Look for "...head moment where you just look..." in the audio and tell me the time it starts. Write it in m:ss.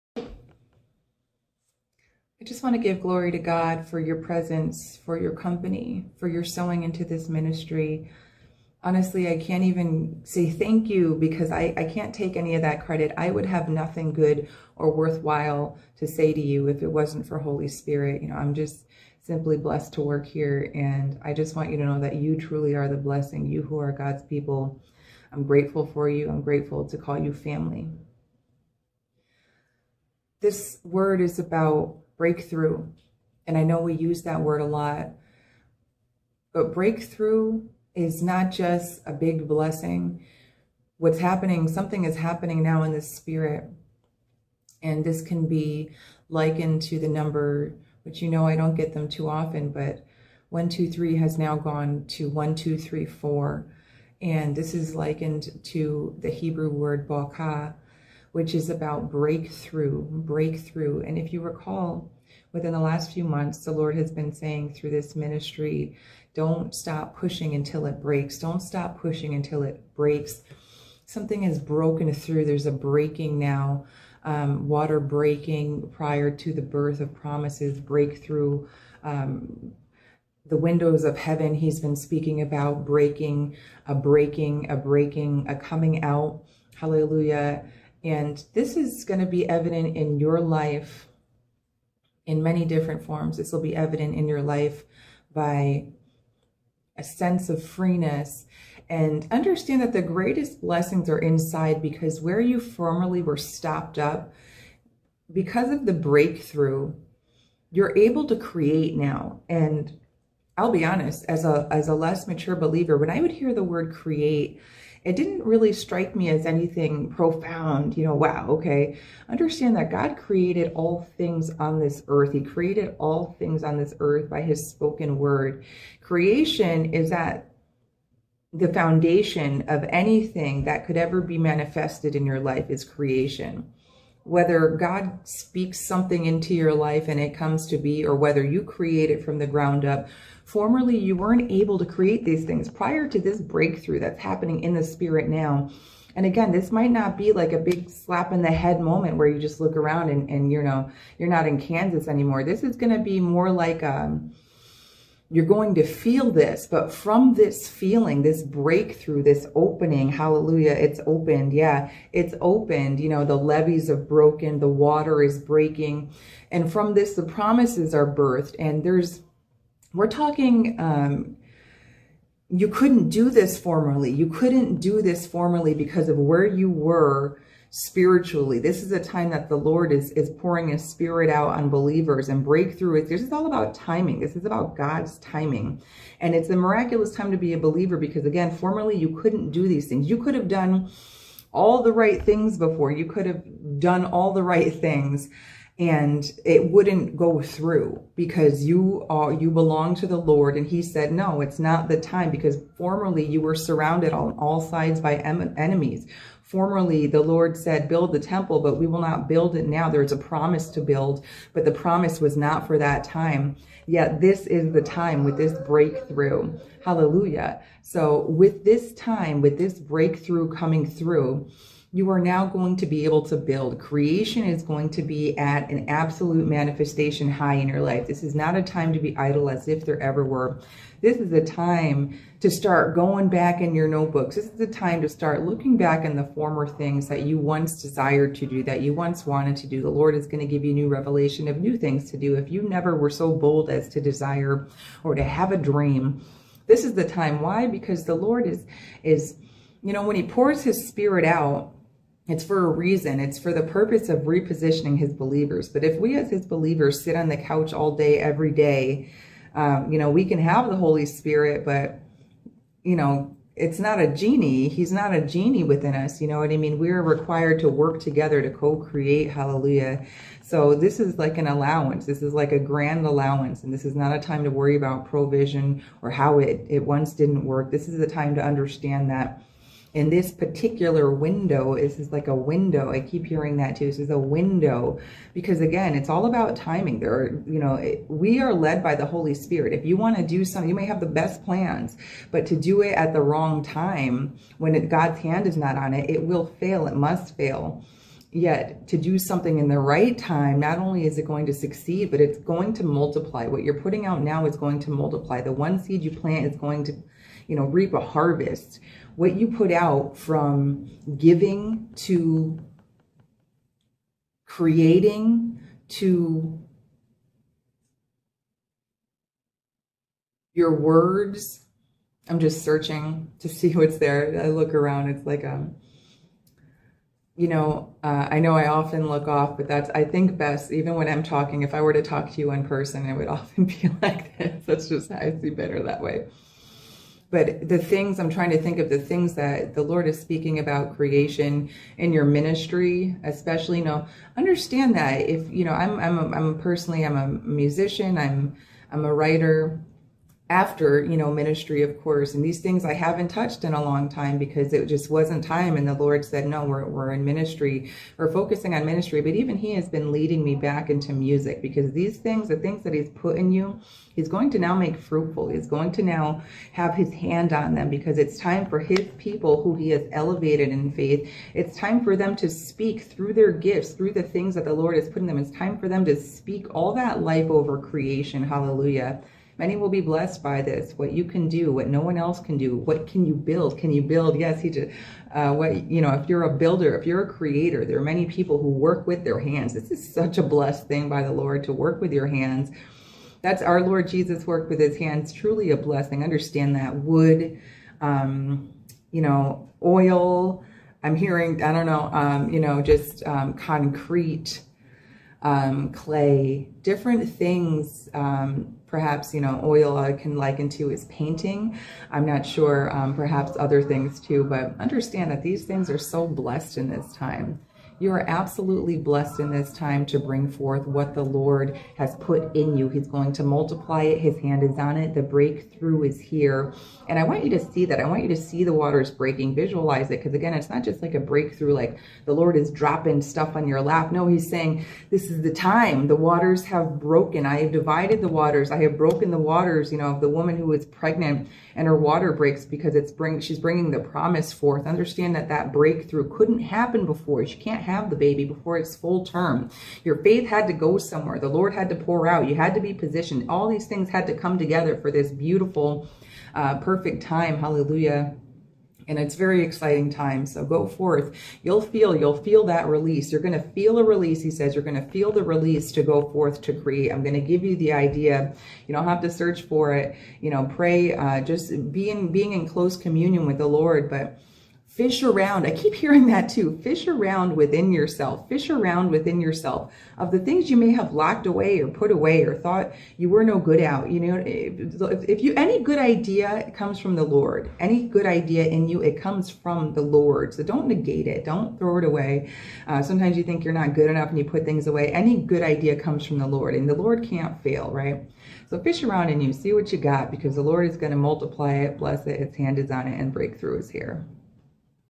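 2:28.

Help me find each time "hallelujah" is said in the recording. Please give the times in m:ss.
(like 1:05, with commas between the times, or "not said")
1:26, 2:40, 3:36, 4:29, 6:18, 7:37.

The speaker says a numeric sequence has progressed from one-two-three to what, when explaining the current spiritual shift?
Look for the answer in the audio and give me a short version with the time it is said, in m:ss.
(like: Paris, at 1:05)
1, 2, 3, 4, at 0:52.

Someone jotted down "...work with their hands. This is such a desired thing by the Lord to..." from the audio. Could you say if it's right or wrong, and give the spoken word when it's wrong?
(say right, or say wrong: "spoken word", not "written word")
wrong: "blessed", not "desired".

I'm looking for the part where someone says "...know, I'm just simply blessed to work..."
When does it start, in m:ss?
0:18.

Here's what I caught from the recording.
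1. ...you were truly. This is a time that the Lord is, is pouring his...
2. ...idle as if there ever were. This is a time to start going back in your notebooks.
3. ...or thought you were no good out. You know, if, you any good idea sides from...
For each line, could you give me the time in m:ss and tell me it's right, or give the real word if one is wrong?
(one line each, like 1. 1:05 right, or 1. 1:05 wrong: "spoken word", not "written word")
1. 2:56 wrong: "spiritually", not "truly"
2. 3:49 right
3. 8:02 wrong: "comes", not "sides".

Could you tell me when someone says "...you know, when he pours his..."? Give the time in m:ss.
4:09.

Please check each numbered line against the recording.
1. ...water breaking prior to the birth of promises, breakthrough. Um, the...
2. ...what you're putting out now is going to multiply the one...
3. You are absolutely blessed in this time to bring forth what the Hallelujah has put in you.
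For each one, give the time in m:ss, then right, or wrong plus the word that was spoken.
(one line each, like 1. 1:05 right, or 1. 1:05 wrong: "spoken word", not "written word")
1. 1:14 right
2. 5:03 right
3. 6:58 wrong: "Lord", not "Hallelujah".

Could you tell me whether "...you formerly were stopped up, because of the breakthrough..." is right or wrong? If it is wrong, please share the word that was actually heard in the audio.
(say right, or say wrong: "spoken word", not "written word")
right.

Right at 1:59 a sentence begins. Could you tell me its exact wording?
Understand that God created all things on this earth.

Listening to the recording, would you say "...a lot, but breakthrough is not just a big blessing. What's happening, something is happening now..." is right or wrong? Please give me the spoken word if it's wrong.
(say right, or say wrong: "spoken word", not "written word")
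right.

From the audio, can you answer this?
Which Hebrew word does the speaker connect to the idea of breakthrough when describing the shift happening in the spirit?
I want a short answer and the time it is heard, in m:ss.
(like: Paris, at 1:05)
balka, at 0:57.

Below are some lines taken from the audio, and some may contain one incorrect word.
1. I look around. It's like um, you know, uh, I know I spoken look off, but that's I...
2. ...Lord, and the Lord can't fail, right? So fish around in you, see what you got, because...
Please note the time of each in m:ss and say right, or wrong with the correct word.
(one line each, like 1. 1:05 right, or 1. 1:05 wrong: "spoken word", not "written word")
1. 5:24 wrong: "often", not "spoken"
2. 8:16 right.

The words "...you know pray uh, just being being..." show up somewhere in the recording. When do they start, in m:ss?
7:50.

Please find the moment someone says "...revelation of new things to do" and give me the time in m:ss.
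4:00.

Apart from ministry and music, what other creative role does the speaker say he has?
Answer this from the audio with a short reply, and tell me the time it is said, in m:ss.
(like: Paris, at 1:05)
writer, at 5:49.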